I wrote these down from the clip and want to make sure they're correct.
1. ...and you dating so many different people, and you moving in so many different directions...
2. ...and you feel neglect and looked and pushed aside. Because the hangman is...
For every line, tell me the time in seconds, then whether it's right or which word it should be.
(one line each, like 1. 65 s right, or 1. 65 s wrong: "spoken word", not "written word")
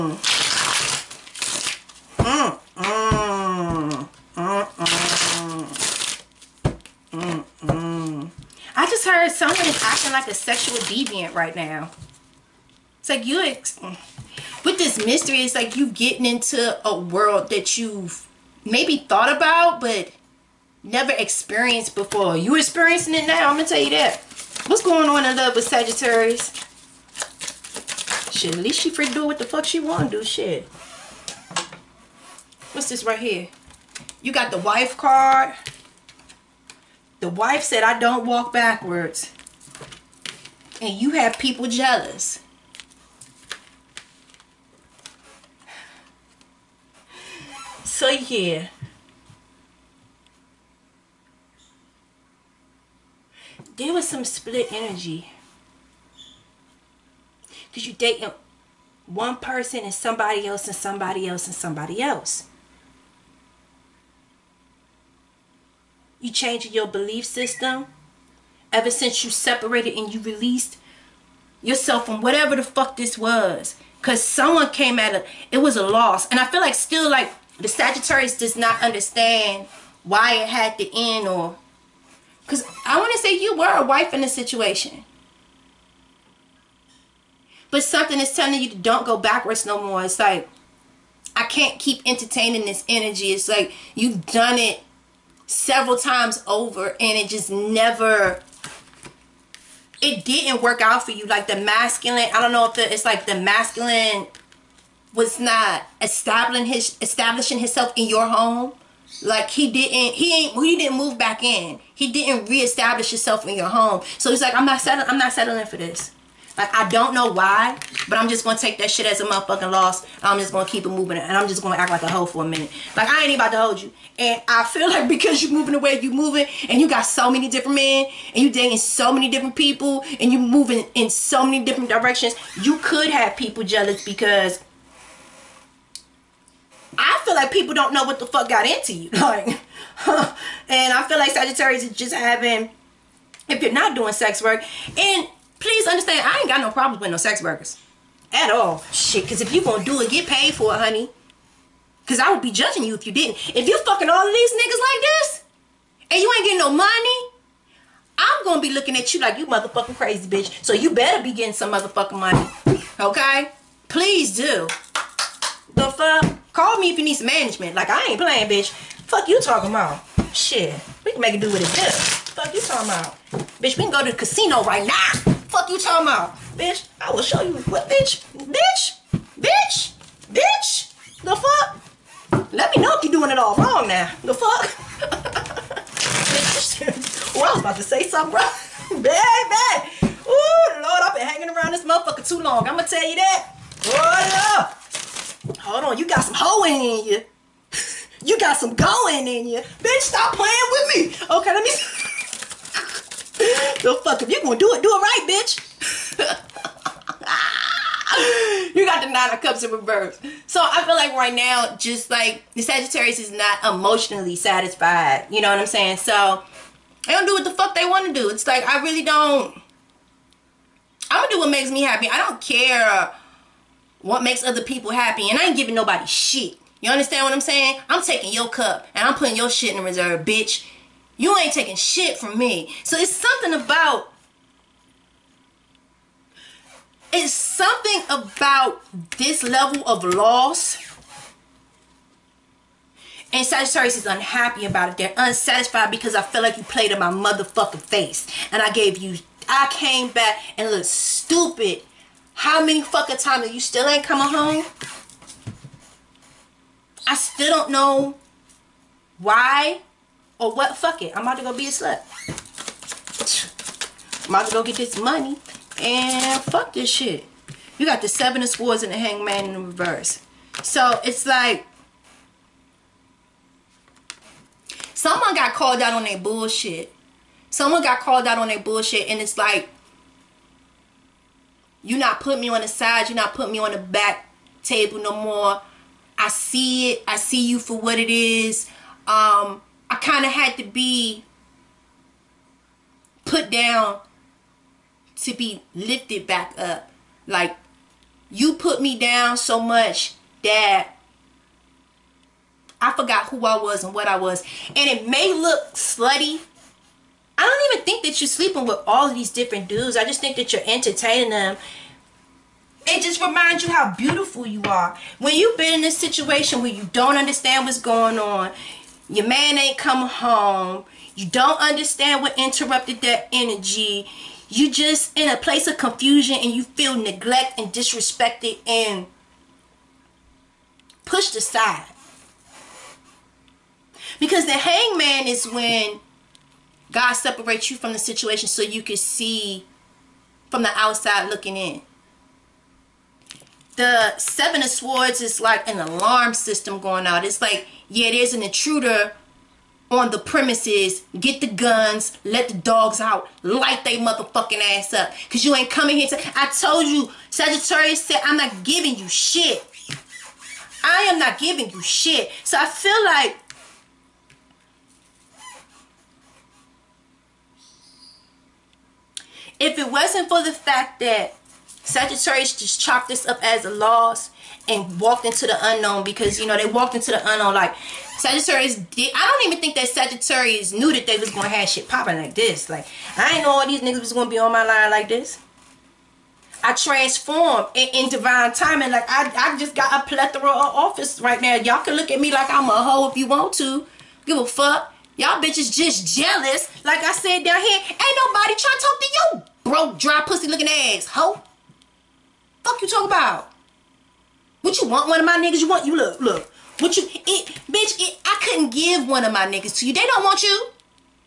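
1. 128 s right
2. 326 s wrong: "disrespected", not "looked".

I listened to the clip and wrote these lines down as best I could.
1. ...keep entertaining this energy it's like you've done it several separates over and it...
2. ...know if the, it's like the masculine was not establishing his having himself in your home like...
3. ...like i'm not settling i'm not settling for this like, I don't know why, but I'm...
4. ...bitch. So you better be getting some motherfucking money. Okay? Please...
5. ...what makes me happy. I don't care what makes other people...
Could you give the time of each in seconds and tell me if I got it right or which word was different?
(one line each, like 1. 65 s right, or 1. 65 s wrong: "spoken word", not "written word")
1. 91 s wrong: "times", not "separates"
2. 102 s wrong: "establishing", not "having"
3. 114 s right
4. 160 s right
5. 221 s right.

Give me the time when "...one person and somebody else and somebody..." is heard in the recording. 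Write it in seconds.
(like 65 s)
59 s.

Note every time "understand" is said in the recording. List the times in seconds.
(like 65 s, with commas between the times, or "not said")
78 s, 145 s, 226 s, 317 s, 321 s.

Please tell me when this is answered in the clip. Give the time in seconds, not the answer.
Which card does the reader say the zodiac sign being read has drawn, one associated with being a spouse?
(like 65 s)
34 s.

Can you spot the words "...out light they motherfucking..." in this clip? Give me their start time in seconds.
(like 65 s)
352 s.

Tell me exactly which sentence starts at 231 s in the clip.
You ain't taking shit from me.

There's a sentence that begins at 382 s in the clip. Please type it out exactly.
Like I didn't know all these niggas was gonna be on my line like this.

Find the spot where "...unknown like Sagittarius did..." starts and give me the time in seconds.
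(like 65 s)
377 s.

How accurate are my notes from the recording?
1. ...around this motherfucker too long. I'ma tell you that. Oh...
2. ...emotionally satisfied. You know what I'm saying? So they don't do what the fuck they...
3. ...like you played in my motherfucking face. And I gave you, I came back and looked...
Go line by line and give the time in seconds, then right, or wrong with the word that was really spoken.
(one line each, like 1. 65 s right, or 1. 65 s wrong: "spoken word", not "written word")
1. 191 s right
2. 213 s right
3. 246 s right.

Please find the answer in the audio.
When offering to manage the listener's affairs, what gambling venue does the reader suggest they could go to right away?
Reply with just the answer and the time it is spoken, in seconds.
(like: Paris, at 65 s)
The casino, at 174 s.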